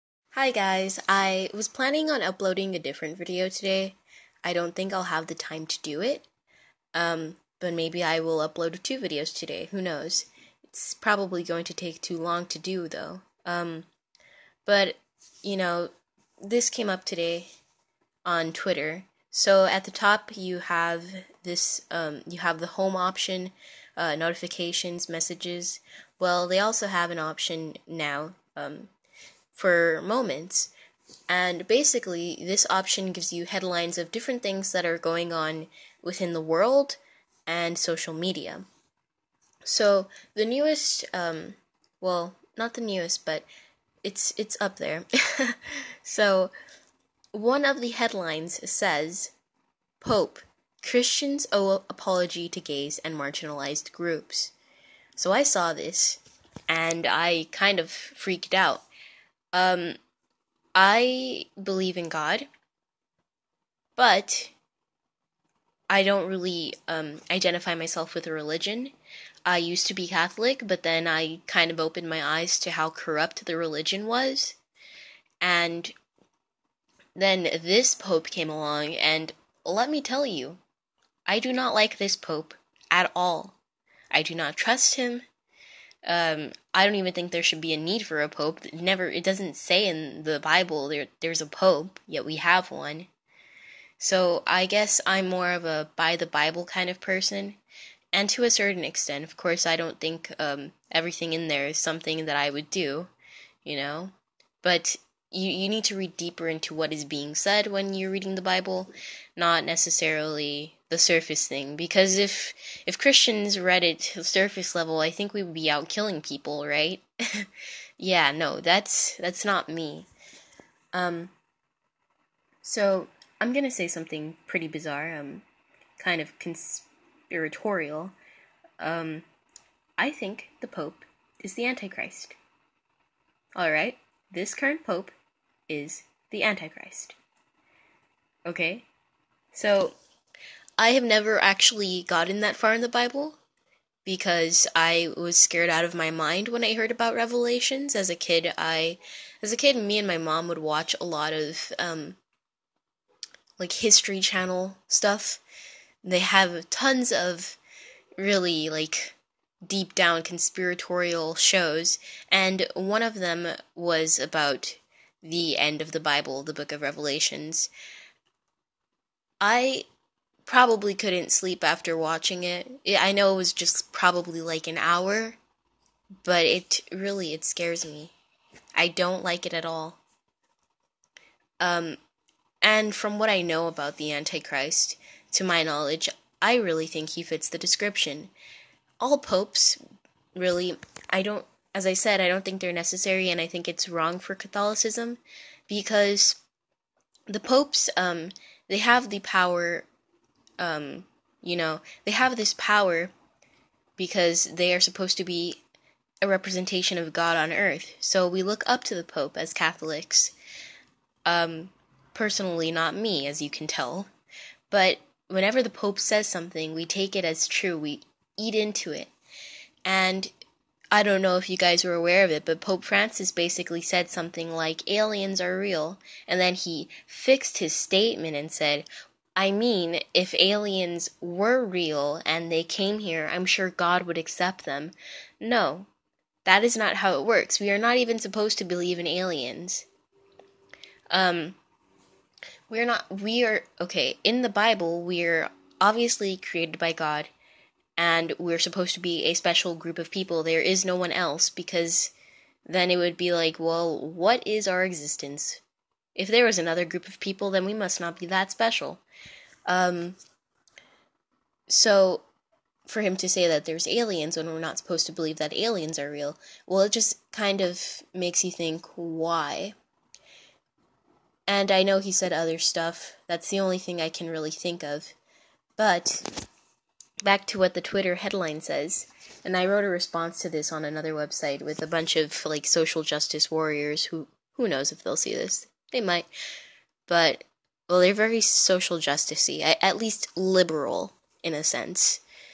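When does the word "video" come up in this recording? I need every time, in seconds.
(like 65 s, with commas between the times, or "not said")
3 s, 8 s.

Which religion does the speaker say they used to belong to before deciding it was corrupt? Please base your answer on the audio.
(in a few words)
Catholic.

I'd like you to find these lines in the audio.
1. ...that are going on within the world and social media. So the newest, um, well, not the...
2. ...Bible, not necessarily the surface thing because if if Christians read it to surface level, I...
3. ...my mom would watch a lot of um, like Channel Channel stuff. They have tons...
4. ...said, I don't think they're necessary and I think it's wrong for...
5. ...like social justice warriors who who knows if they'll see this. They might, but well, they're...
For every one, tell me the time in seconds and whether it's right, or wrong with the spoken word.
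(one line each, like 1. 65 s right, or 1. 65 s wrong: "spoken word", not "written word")
1. 34 s right
2. 108 s right
3. 150 s wrong: "History", not "Channel"
4. 191 s right
5. 282 s right.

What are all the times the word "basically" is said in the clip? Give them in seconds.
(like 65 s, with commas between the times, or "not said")
31 s, 223 s.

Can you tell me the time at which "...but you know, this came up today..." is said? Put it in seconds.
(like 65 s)
14 s.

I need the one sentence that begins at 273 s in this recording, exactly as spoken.
That's the only thing I can really think of.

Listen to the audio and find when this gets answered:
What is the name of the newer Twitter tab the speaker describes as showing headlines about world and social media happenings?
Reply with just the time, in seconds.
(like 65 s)
30 s.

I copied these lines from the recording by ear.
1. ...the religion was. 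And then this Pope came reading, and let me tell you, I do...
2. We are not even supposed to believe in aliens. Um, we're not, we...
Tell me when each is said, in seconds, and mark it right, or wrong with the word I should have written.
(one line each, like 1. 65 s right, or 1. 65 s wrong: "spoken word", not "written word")
1. 73 s wrong: "along", not "reading"
2. 237 s right.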